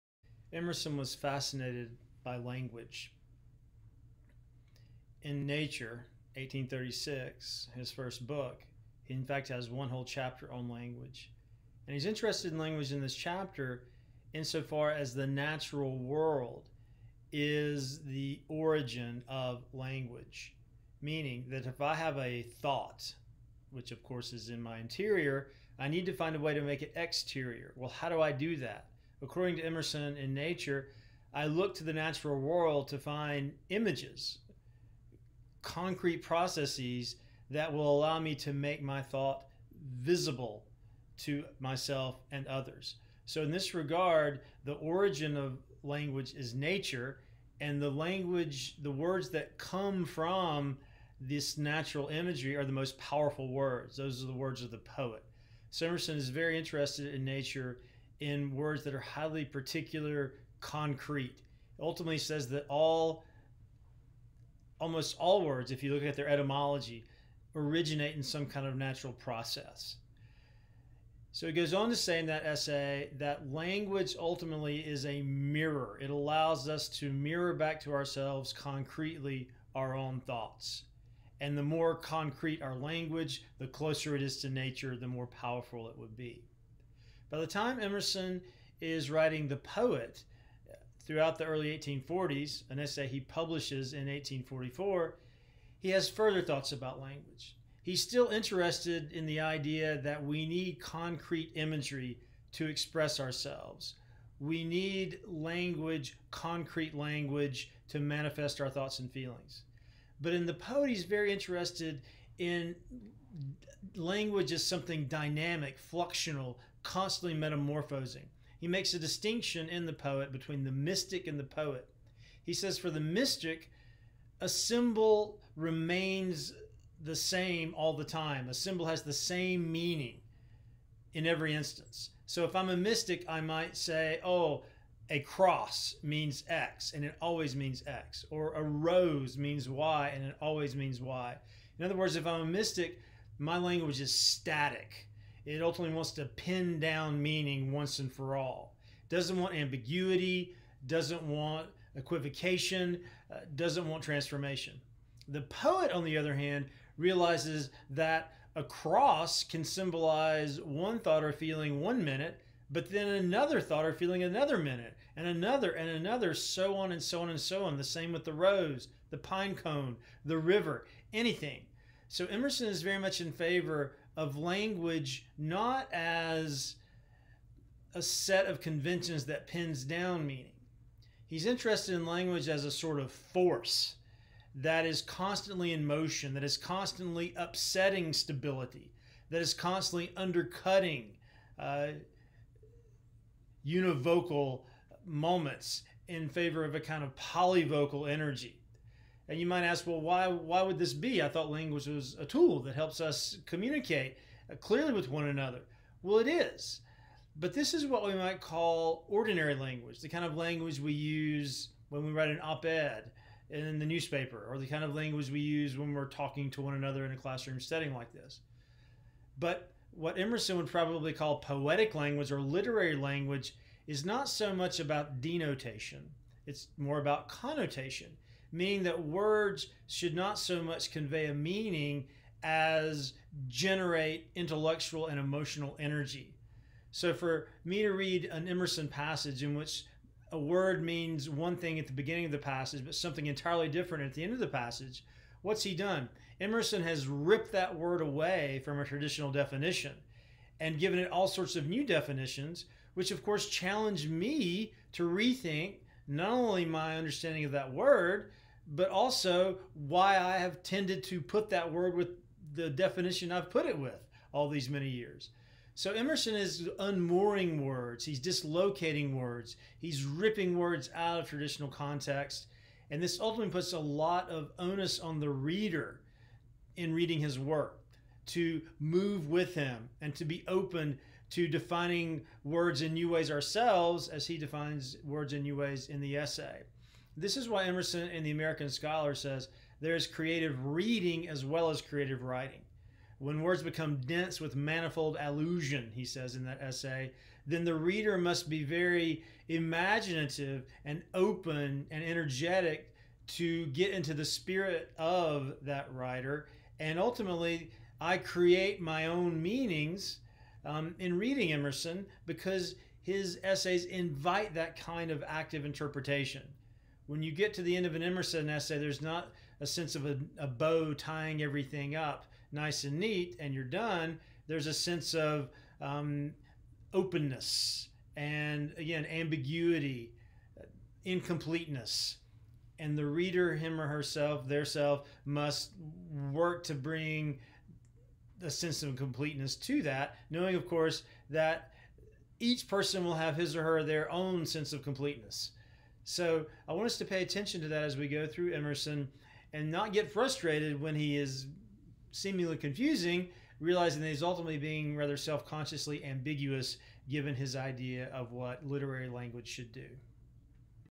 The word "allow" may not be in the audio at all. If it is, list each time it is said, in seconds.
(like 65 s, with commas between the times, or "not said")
37 s, 76 s.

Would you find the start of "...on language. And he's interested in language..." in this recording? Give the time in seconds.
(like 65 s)
10 s.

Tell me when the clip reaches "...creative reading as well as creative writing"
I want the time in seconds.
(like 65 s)
290 s.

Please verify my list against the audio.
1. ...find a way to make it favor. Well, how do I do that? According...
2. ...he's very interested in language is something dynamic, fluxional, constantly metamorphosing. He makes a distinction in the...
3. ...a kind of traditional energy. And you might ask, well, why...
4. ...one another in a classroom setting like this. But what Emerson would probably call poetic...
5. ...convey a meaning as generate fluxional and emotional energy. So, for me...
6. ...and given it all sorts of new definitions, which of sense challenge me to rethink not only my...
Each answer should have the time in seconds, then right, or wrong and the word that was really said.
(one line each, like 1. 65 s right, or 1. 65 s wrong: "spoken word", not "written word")
1. 26 s wrong: "exterior", not "favor"
2. 110 s right
3. 196 s wrong: "polyvocal", not "traditional"
4. 216 s right
5. 230 s wrong: "intellectual", not "fluxional"
6. 250 s wrong: "course", not "sense".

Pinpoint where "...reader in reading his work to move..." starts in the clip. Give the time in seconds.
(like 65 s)
275 s.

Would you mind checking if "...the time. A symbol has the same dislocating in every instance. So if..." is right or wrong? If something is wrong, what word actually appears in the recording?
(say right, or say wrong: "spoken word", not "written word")
wrong: "meaning", not "dislocating".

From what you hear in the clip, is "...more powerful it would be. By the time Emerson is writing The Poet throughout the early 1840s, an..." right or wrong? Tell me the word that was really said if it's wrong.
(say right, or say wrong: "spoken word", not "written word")
right.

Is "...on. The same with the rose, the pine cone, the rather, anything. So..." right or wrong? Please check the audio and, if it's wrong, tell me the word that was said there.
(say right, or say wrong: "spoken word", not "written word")
wrong: "river", not "rather".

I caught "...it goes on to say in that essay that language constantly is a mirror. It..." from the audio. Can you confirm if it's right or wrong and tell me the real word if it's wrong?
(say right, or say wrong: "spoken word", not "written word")
wrong: "ultimately", not "constantly".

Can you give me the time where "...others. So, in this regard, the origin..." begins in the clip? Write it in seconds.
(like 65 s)
42 s.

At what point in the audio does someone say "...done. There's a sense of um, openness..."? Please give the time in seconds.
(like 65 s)
323 s.